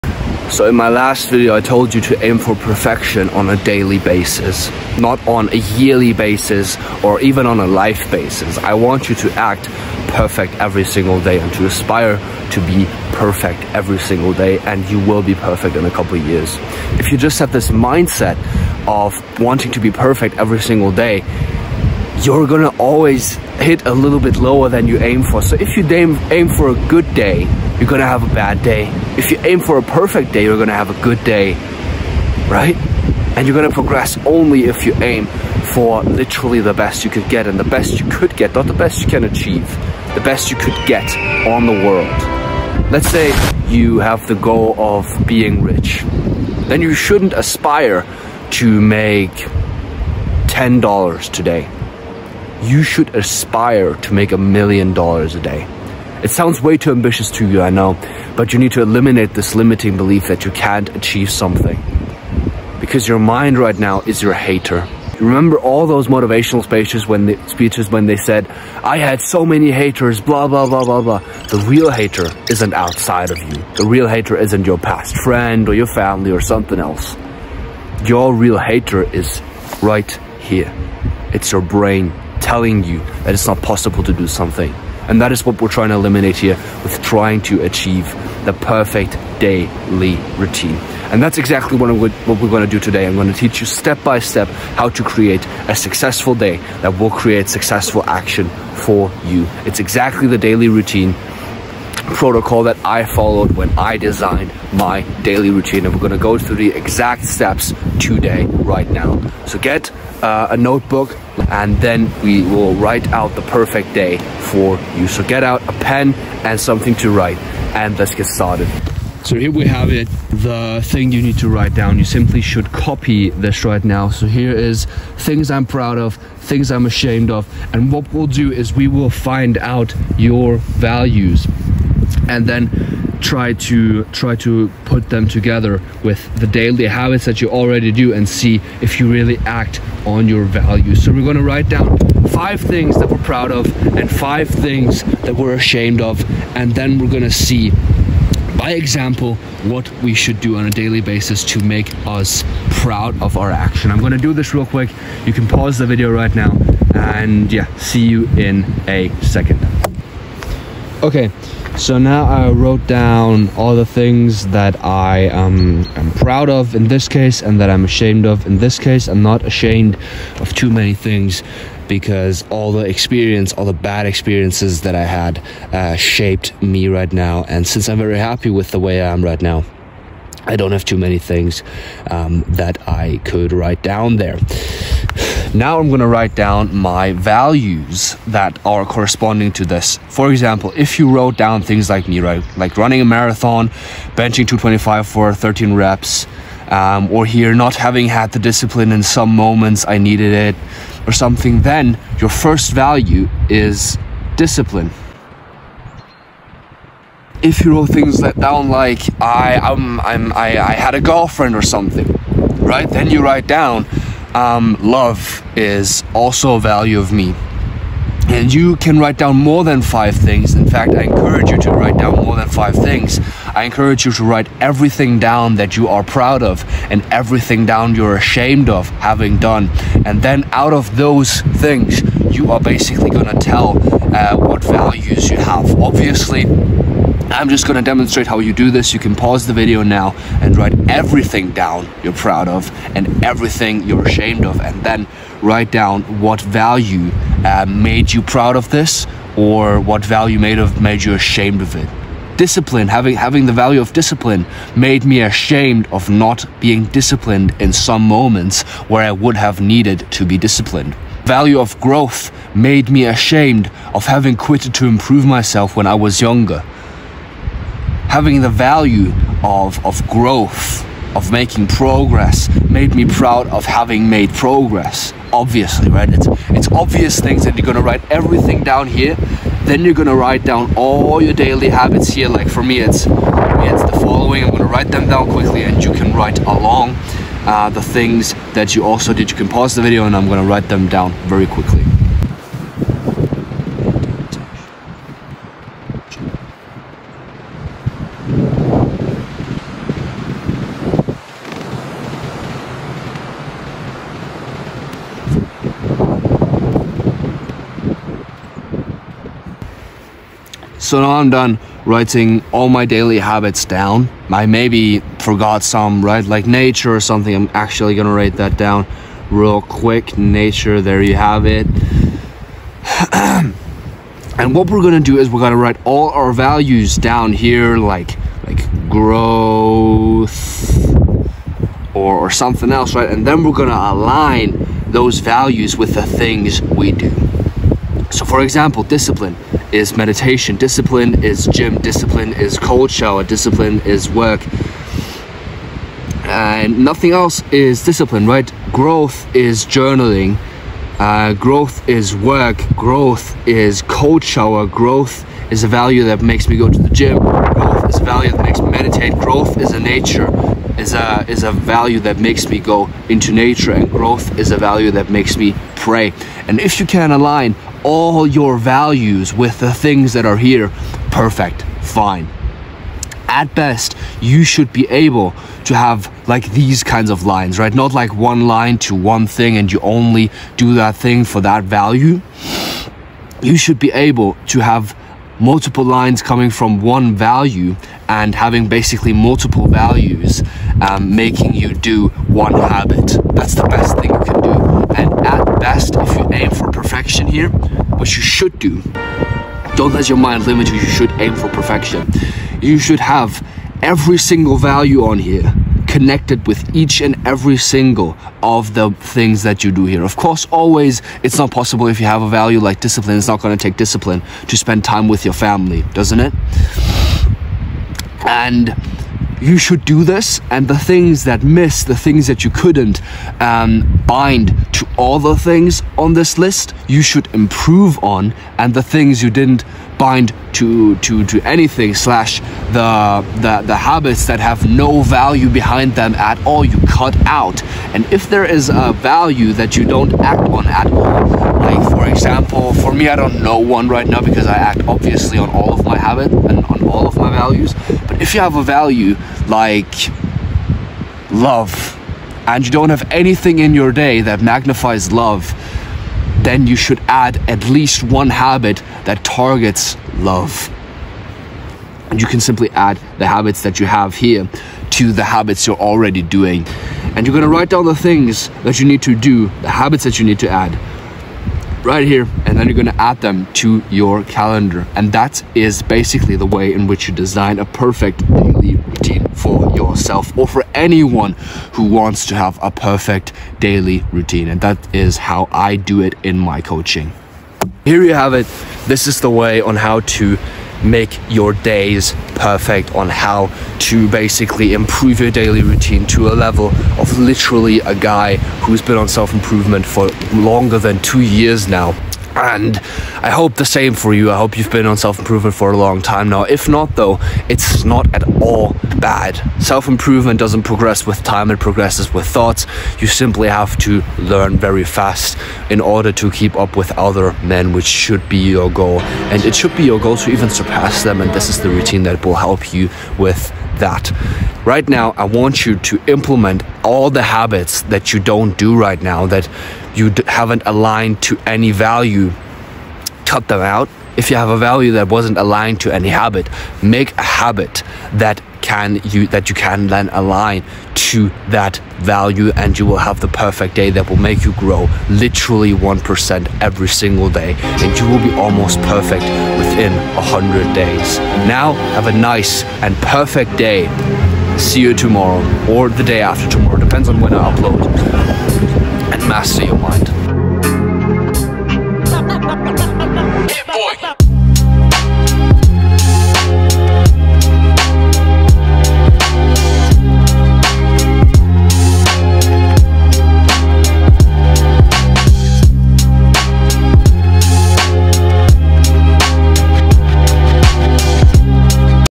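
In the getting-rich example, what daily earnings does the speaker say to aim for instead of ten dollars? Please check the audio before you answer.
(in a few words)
a million dollars.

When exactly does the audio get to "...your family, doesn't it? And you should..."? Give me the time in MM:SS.
06:55.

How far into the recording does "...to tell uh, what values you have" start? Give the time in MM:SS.
03:53.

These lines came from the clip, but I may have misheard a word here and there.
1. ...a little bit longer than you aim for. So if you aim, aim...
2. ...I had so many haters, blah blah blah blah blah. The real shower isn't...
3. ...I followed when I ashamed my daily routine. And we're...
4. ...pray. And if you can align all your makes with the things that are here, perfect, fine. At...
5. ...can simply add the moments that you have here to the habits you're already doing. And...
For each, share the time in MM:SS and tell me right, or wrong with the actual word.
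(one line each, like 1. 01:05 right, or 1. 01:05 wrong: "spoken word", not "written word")
1. 00:23 wrong: "lower", not "longer"
2. 01:08 wrong: "hater", not "shower"
3. 01:42 wrong: "designed", not "ashamed"
4. 06:05 wrong: "values", not "makes"
5. 07:42 wrong: "habits", not "moments".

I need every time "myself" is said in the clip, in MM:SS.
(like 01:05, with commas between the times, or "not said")
04:25.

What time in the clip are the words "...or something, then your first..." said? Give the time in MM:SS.
03:21.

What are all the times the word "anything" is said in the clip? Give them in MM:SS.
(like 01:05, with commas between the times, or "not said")
07:11, 07:33.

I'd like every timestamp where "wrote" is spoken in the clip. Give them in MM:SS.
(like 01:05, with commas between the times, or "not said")
02:42, 03:11, 03:27.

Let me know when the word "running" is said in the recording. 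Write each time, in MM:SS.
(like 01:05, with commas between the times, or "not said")
03:12.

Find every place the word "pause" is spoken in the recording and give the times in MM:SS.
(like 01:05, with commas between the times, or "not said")
02:35, 03:59, 04:49.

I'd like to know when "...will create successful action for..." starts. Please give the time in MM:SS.
01:36.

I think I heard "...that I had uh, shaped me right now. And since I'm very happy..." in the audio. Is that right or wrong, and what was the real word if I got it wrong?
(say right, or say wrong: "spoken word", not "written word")
right.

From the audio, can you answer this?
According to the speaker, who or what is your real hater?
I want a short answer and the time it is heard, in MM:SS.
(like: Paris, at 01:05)
your brain, at 01:21.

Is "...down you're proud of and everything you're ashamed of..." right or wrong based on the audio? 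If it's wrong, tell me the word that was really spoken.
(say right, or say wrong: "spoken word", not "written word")
right.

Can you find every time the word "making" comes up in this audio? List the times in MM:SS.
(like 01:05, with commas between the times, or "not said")
04:31, 06:31.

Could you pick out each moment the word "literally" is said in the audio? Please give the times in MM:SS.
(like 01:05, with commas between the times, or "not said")
00:36, 08:17, 09:05.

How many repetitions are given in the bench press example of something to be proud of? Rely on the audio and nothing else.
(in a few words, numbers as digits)
13.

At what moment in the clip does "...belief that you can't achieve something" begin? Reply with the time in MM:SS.
00:59.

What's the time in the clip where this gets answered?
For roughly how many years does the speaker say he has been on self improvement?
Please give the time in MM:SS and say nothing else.
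08:21.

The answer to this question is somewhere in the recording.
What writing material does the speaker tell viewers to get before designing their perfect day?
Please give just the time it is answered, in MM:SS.
01:50.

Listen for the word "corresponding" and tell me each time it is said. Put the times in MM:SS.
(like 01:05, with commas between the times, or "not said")
03:08.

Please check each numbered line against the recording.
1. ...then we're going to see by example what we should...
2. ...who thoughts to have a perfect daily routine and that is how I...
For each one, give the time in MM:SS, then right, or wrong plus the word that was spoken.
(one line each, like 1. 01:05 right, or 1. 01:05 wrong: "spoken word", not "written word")
1. 02:26 right
2. 08:01 wrong: "wants", not "thoughts".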